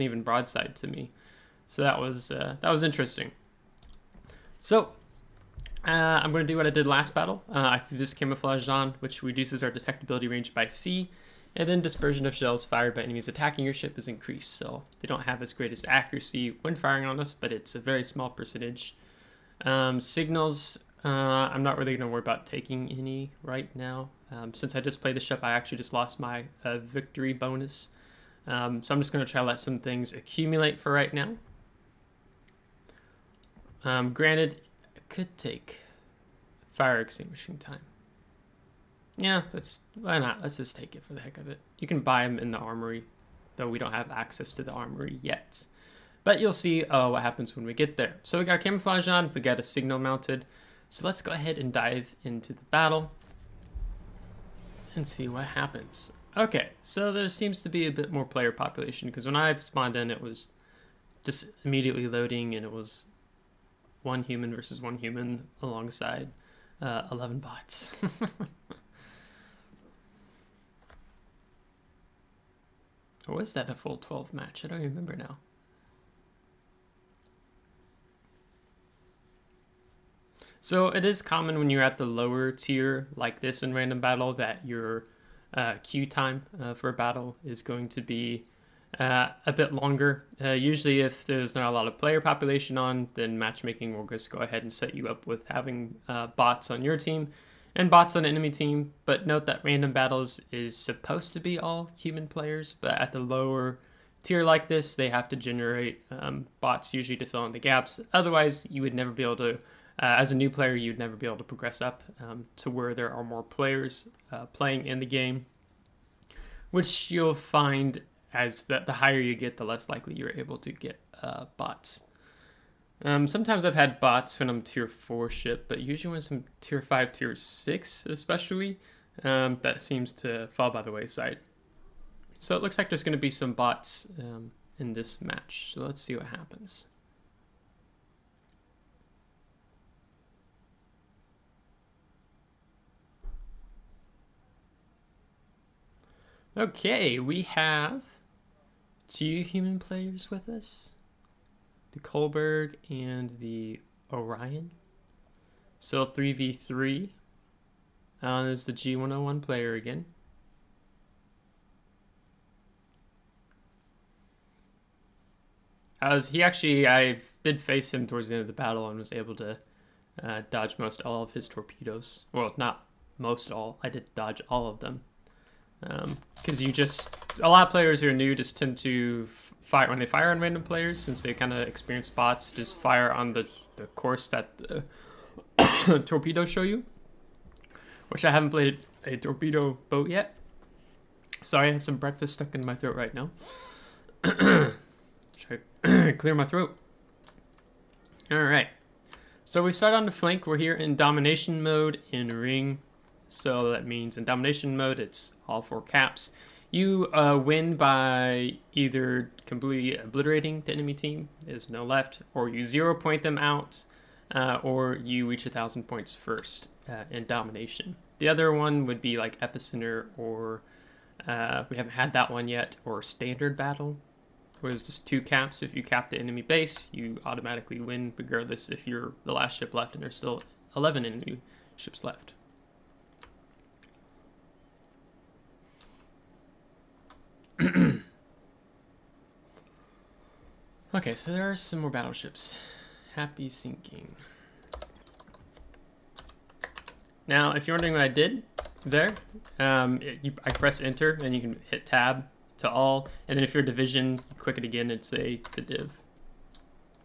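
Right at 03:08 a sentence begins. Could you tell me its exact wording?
Which I haven't played a torpedo boat yet.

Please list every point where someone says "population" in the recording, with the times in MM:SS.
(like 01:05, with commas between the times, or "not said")
00:58, 01:32.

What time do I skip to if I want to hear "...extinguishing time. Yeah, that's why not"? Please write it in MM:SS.
00:37.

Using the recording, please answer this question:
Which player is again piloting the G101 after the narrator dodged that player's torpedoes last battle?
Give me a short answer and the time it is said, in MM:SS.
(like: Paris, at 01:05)
Alan, at 02:38.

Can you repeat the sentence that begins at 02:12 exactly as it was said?
So it looks like there's going to be some bots um, in this match, so let's see what happens.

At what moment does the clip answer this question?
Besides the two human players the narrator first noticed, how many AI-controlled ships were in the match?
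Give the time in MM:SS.
01:07.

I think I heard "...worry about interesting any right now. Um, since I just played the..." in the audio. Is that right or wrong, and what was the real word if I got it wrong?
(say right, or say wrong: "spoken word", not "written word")
wrong: "taking", not "interesting".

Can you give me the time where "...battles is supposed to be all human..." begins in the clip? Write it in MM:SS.
01:39.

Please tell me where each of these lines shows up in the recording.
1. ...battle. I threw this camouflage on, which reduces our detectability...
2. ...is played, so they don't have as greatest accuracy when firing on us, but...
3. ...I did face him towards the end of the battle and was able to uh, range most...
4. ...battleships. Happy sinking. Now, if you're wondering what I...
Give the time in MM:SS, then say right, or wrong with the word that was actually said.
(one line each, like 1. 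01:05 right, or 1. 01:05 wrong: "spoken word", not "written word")
1. 00:07 right
2. 00:13 wrong: "increased", not "played"
3. 02:46 wrong: "dodge", not "range"
4. 04:01 right.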